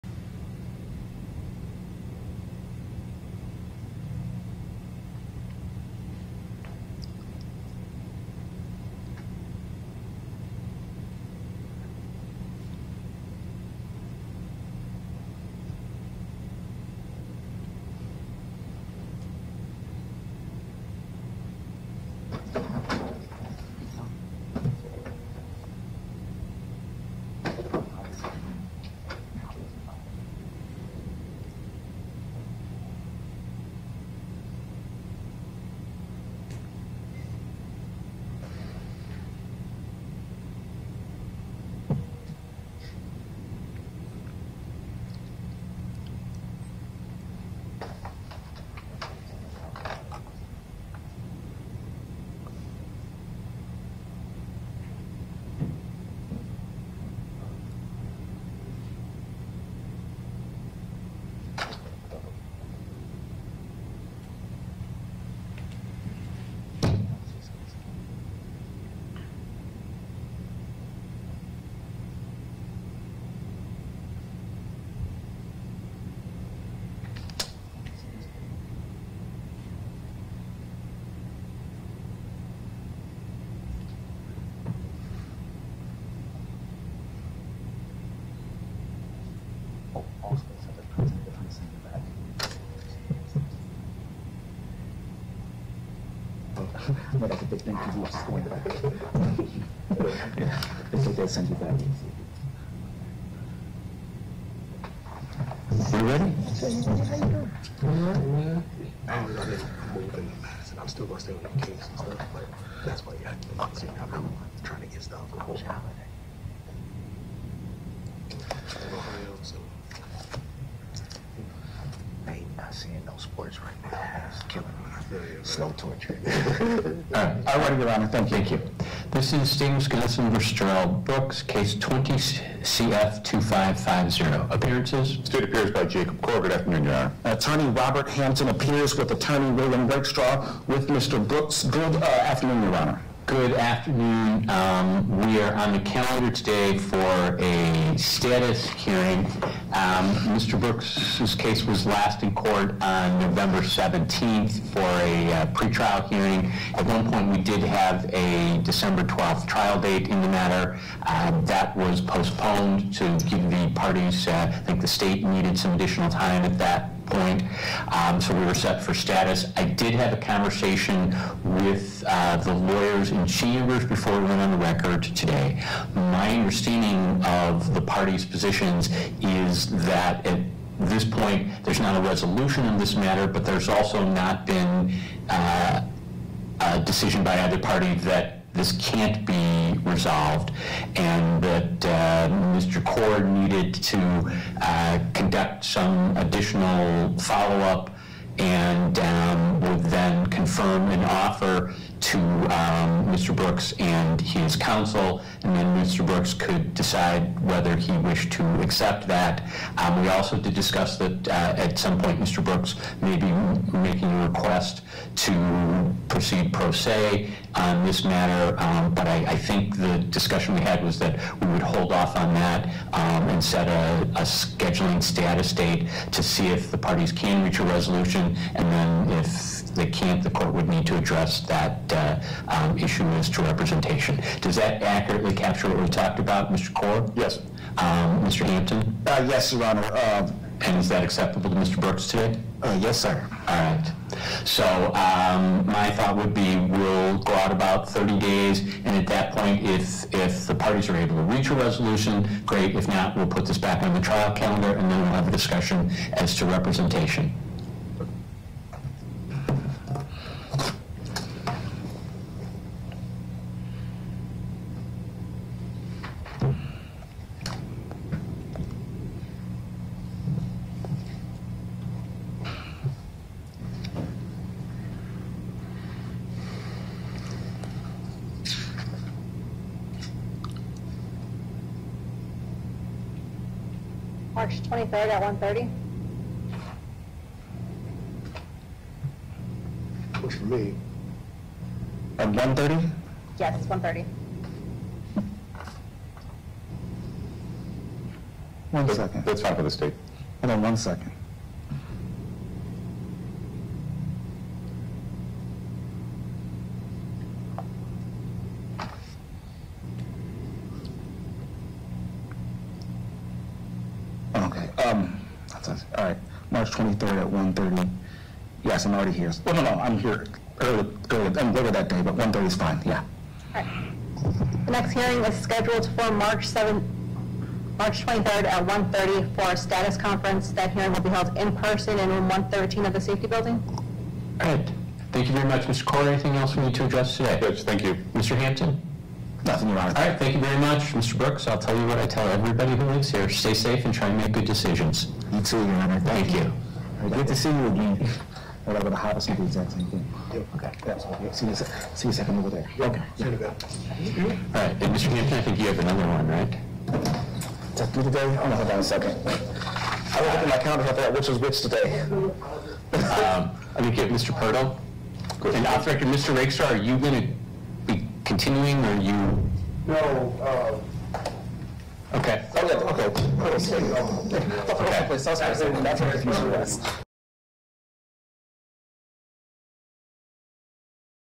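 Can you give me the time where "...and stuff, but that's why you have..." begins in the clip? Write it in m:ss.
1:51.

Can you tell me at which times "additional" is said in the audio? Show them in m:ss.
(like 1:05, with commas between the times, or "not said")
2:45, 3:16.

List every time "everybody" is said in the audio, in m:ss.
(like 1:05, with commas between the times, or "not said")
5:42.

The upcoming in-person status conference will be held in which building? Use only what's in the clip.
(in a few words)
Safety building.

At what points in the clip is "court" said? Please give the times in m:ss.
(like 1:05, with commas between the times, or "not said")
2:32, 3:50.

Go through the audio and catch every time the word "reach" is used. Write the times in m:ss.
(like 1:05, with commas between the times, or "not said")
3:47, 4:11.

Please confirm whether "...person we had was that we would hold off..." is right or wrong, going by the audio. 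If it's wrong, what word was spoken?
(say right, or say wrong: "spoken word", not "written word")
wrong: "discussion", not "person".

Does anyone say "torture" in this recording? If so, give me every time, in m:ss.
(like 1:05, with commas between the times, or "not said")
2:05.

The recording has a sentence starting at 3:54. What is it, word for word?
Does that accurately capture what we talked about, Mr.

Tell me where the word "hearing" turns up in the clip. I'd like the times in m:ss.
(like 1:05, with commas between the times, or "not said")
2:28, 2:36, 5:24, 5:30.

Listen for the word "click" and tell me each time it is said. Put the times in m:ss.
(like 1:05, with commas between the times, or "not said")
not said.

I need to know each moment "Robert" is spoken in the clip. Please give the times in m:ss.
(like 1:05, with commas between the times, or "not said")
2:17.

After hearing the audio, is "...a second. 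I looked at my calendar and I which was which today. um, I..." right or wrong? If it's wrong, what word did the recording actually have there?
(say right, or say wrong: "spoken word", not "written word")
right.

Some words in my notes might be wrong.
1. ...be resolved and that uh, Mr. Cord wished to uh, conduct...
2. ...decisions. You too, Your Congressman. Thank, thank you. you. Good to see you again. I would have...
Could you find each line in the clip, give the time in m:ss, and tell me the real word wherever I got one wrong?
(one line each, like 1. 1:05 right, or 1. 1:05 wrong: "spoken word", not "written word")
1. 3:09 wrong: "needed", not "wished"
2. 5:44 wrong: "Honor", not "Congressman".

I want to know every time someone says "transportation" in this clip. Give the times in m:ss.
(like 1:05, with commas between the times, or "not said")
not said.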